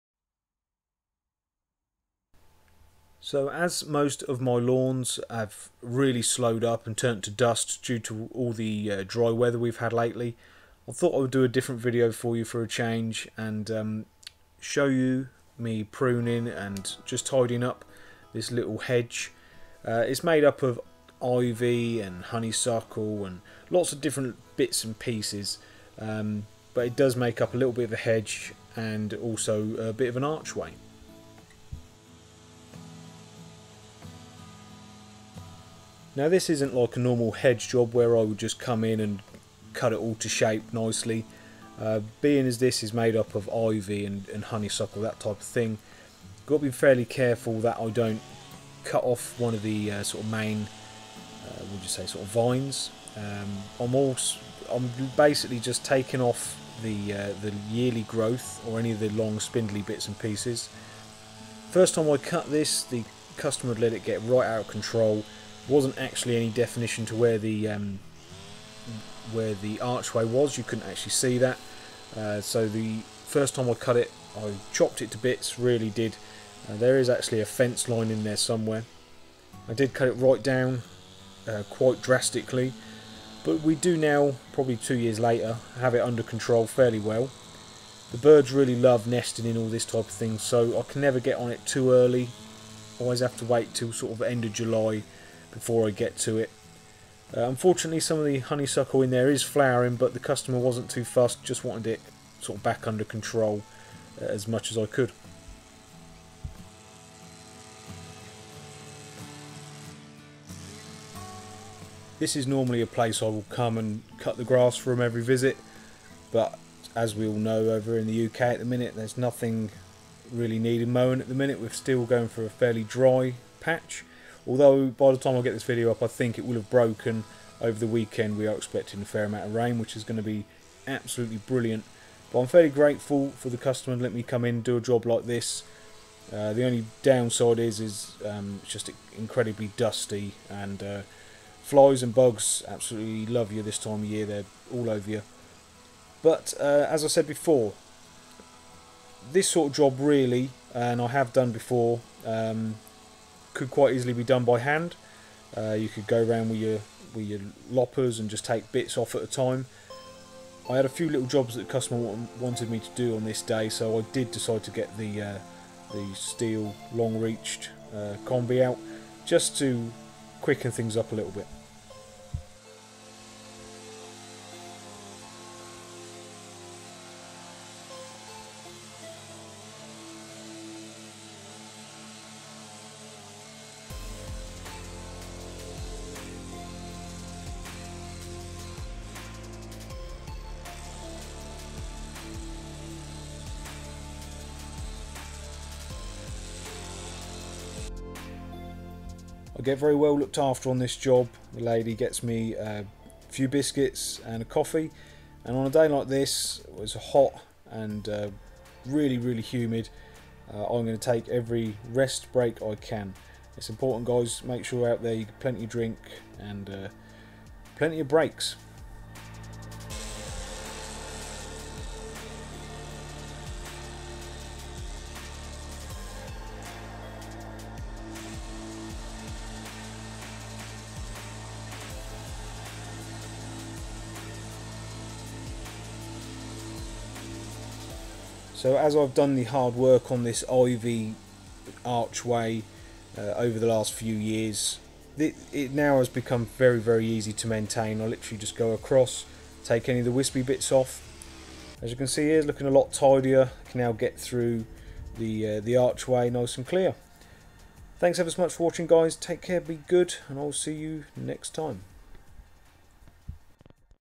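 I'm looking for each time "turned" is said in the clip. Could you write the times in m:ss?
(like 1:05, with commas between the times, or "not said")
0:06.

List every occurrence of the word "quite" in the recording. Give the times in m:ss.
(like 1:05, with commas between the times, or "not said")
1:21, 2:33.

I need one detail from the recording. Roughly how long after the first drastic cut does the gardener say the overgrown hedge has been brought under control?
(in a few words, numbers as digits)
2 years.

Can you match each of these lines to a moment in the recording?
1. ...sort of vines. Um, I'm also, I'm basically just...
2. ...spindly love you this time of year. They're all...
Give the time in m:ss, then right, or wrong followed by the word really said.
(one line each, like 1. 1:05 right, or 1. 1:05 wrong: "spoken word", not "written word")
1. 0:52 right
2. 2:22 wrong: "absolutely", not "spindly".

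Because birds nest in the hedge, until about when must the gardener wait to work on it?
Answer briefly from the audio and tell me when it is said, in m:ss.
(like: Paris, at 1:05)
End of July, at 1:34.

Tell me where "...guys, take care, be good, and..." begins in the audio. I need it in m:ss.
4:18.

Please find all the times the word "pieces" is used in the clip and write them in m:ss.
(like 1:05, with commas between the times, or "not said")
0:24, 1:00.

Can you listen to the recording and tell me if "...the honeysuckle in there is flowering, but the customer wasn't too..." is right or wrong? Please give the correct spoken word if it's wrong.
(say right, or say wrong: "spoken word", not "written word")
right.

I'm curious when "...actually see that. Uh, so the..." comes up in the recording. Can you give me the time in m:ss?
1:10.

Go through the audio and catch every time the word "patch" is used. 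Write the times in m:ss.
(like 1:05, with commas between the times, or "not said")
2:03.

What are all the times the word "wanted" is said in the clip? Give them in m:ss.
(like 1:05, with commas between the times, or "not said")
1:41, 2:42.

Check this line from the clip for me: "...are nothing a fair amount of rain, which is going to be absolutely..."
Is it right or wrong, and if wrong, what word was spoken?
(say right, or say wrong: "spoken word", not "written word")
wrong: "expecting", not "nothing".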